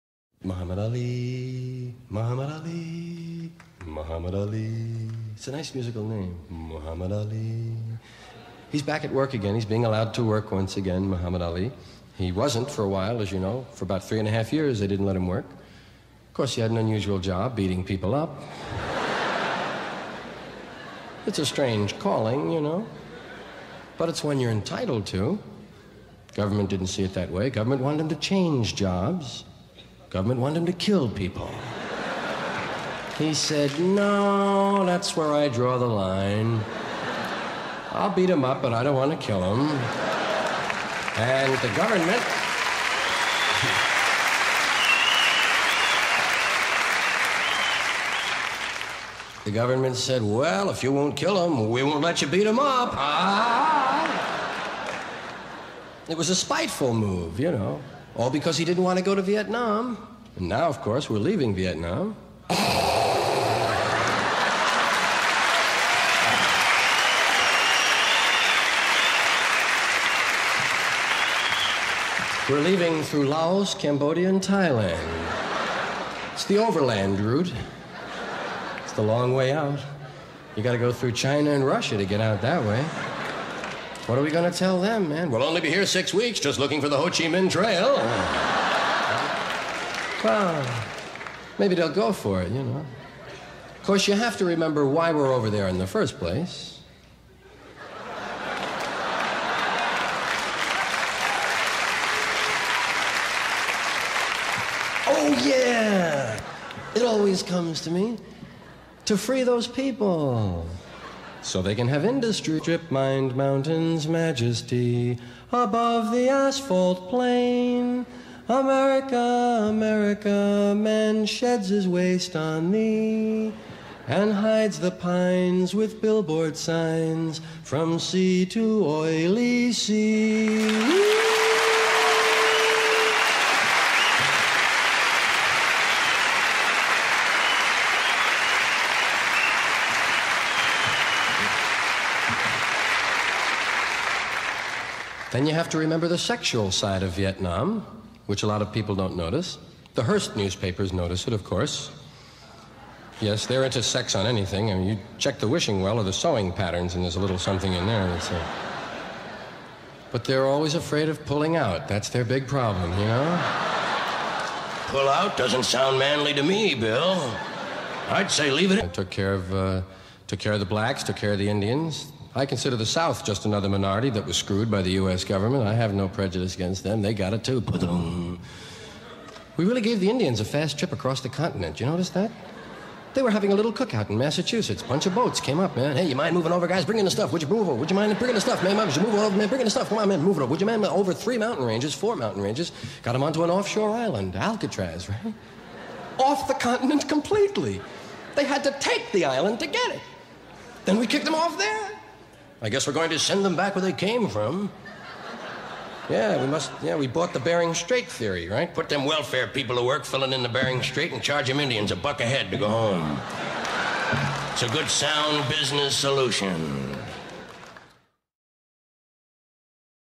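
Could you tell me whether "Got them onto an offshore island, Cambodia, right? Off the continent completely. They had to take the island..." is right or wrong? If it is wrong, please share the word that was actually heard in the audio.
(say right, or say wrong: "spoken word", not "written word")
wrong: "Alcatraz", not "Cambodia".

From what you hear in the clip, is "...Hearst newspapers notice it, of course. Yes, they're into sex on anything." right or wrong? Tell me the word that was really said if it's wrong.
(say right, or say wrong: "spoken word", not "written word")
right.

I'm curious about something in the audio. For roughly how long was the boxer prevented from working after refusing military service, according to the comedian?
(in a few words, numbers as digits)
3.5 years.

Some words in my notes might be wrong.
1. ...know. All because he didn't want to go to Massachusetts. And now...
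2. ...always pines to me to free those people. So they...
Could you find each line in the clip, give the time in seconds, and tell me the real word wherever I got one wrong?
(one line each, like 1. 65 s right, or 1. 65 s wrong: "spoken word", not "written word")
1. 57 s wrong: "Vietnam", not "Massachusetts"
2. 107 s wrong: "comes", not "pines".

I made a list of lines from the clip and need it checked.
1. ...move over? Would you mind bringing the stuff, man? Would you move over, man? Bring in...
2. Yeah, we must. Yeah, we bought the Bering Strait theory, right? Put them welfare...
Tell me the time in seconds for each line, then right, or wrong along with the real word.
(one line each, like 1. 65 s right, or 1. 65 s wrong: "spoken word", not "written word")
1. 187 s right
2. 206 s right.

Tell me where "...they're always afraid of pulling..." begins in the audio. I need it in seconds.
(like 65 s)
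160 s.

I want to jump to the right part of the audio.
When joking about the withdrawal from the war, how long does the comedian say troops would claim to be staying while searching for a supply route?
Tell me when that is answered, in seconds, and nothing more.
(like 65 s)
85 s.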